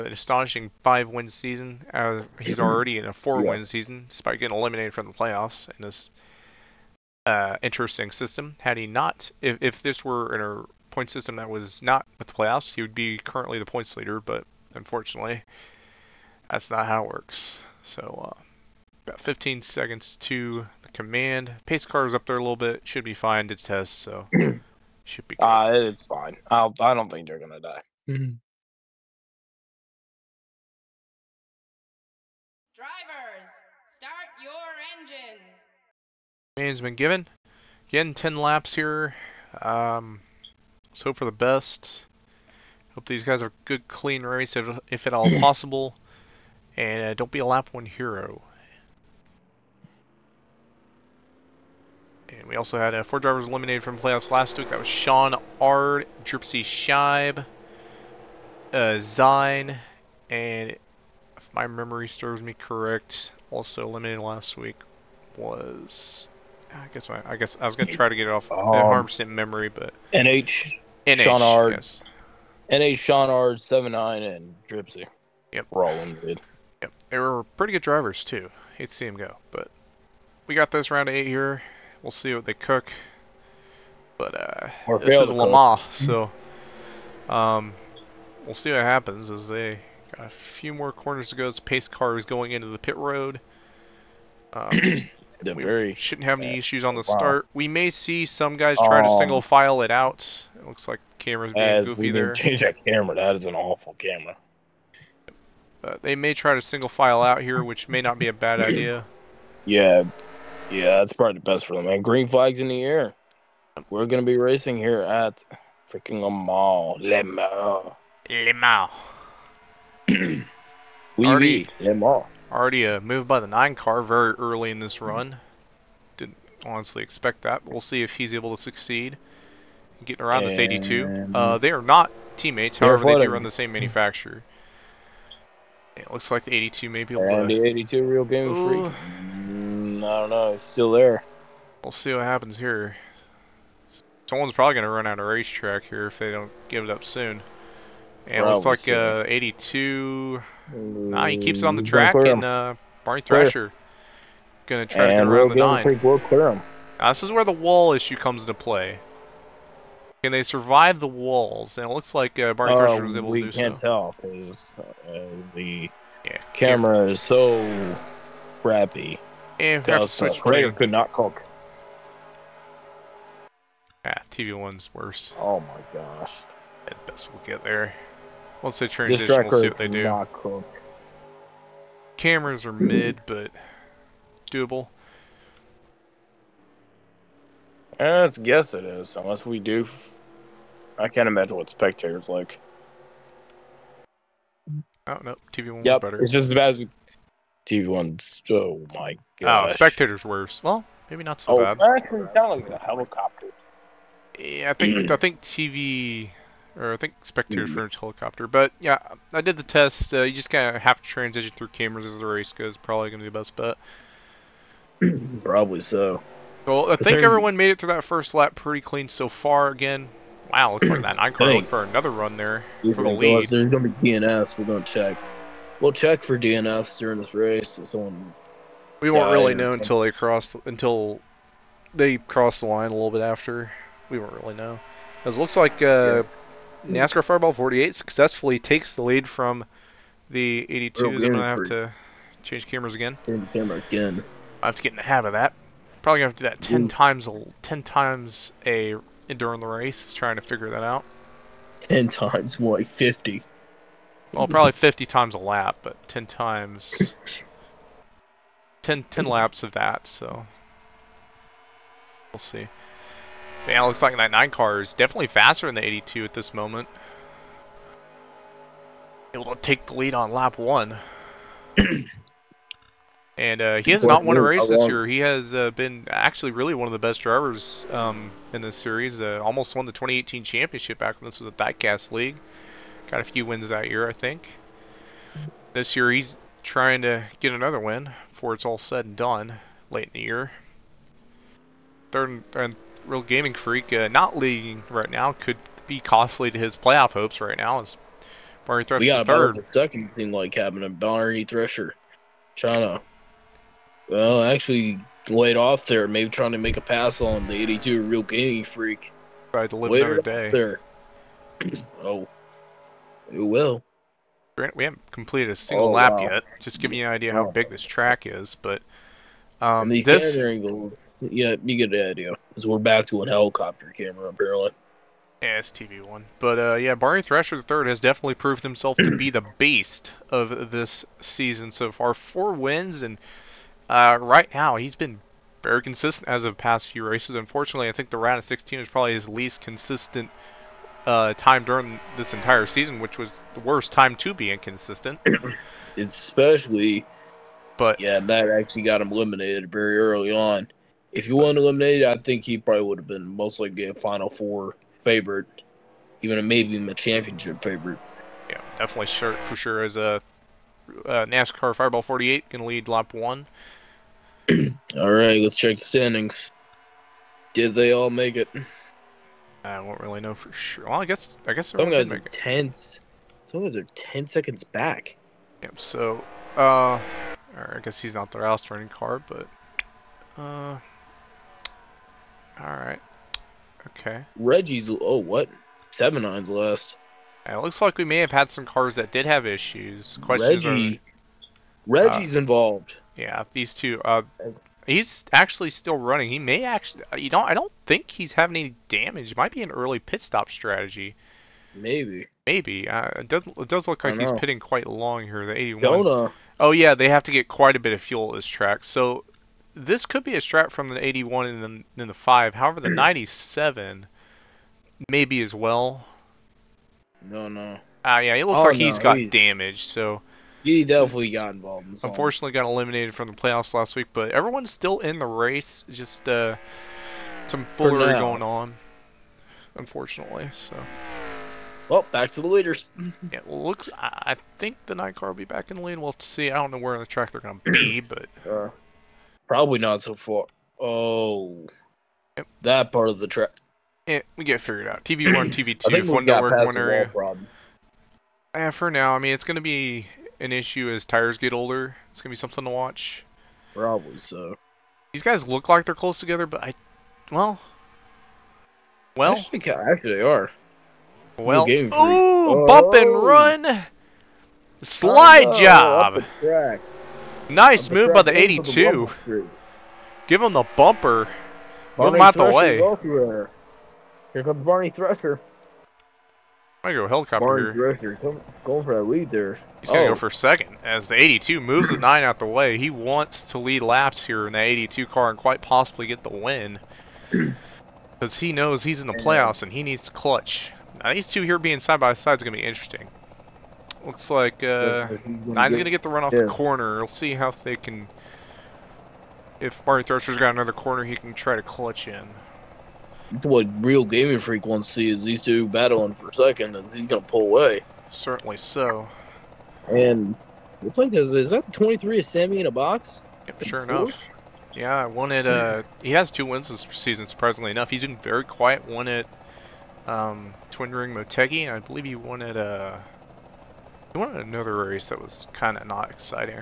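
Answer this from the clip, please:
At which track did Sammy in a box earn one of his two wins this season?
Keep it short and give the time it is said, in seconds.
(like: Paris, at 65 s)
Twin Ring Motegi, at 520 s.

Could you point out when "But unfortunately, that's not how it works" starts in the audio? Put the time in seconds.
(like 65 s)
14 s.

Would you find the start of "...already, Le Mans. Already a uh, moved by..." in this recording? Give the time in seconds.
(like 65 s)
121 s.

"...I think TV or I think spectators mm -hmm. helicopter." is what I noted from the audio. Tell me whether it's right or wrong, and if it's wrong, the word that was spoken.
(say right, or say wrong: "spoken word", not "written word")
right.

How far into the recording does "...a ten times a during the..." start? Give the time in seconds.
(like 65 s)
247 s.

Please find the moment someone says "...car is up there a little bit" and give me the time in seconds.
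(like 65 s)
21 s.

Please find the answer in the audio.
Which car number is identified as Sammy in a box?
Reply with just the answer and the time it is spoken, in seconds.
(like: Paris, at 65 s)
23, at 511 s.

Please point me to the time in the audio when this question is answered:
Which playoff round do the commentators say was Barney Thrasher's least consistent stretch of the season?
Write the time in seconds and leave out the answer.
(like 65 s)
338 s.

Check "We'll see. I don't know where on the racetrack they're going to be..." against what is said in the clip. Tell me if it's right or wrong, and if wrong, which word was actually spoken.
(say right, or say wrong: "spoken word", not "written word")
wrong: "track", not "racetrack".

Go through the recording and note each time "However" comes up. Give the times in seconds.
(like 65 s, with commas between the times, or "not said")
132 s, 412 s.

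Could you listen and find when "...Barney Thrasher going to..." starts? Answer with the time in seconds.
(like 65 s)
153 s.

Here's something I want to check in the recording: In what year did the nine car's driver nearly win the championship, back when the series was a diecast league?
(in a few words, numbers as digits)
2018.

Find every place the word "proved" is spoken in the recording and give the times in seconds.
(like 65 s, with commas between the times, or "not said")
328 s.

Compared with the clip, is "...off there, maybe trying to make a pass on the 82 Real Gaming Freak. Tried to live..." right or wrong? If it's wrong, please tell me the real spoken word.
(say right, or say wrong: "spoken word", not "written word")
right.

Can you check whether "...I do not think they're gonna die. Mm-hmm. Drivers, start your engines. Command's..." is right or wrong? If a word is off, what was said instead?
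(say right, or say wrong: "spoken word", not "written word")
right.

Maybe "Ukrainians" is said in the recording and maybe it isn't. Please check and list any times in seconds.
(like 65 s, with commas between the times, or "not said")
not said.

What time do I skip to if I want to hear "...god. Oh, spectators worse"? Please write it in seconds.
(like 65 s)
199 s.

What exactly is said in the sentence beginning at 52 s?
And we also had uh, four drivers eliminated from playoffs last week.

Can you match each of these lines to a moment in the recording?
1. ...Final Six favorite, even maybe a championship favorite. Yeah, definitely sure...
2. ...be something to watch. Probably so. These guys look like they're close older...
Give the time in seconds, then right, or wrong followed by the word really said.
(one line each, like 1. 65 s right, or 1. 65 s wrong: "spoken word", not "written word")
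1. 353 s wrong: "Four", not "Six"
2. 452 s wrong: "together", not "older".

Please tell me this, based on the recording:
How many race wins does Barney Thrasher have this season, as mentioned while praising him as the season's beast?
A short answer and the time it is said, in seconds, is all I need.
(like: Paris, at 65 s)
4, at 332 s.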